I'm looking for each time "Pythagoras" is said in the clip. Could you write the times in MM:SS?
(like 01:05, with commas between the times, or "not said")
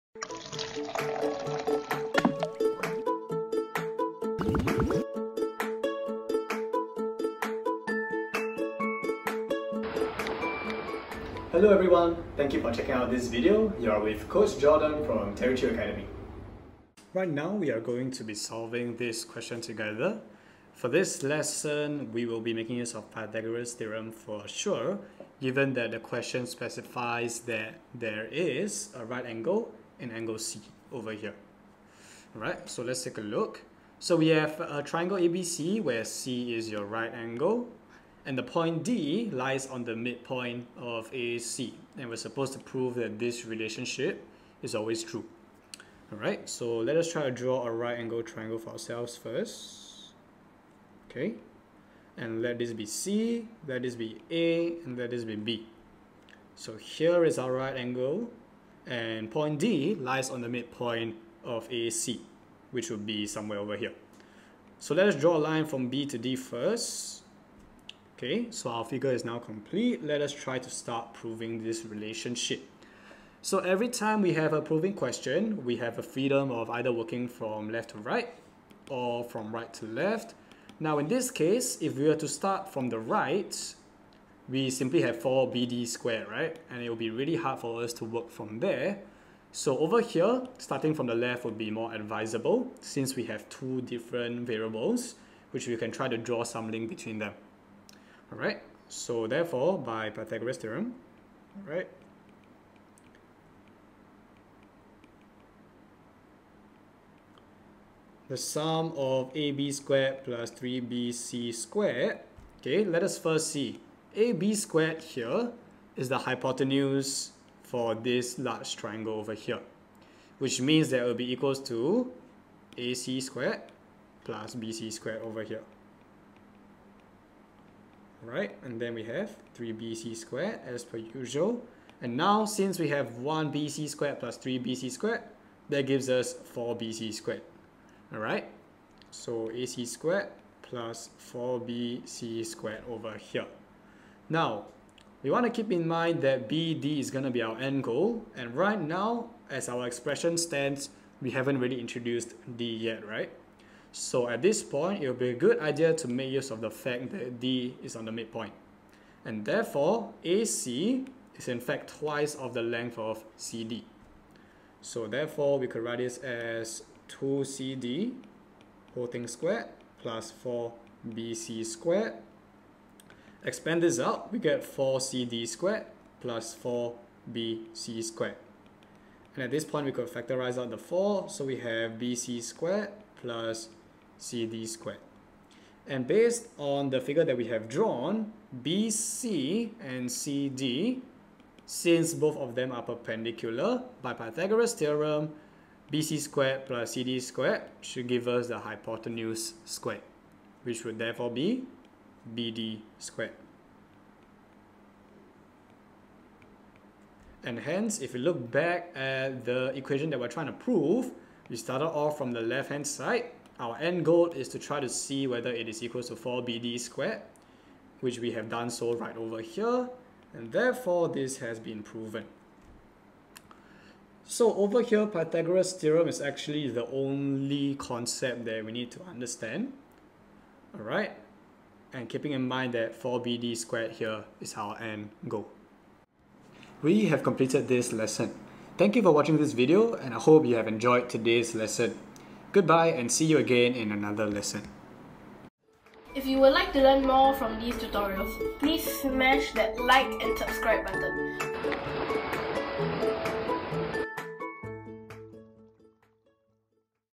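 00:23, 01:40, 03:14, 03:45.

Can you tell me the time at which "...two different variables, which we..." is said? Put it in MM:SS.
01:33.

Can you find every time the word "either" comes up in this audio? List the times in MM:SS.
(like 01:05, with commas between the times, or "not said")
01:16.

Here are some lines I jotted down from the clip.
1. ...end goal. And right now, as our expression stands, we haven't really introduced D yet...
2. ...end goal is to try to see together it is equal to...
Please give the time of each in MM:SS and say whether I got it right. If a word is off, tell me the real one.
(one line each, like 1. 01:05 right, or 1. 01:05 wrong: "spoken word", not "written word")
1. 02:27 right
2. 03:33 wrong: "whether", not "together".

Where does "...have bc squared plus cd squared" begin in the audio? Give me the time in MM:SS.
03:01.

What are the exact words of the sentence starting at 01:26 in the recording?
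And it will be really hard for us to work from there.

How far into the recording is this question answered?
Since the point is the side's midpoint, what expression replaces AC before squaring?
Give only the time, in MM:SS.
02:47.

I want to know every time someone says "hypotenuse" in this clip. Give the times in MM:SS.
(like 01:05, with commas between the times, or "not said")
01:56, 03:18.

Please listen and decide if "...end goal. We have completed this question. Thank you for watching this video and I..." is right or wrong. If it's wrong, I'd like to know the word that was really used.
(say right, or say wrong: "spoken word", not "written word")
wrong: "lesson", not "question".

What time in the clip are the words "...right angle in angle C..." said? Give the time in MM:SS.
00:29.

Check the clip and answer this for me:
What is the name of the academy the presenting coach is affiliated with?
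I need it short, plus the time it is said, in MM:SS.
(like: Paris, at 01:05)
Terry Chew Academy, at 00:15.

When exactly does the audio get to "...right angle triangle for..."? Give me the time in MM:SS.
00:47.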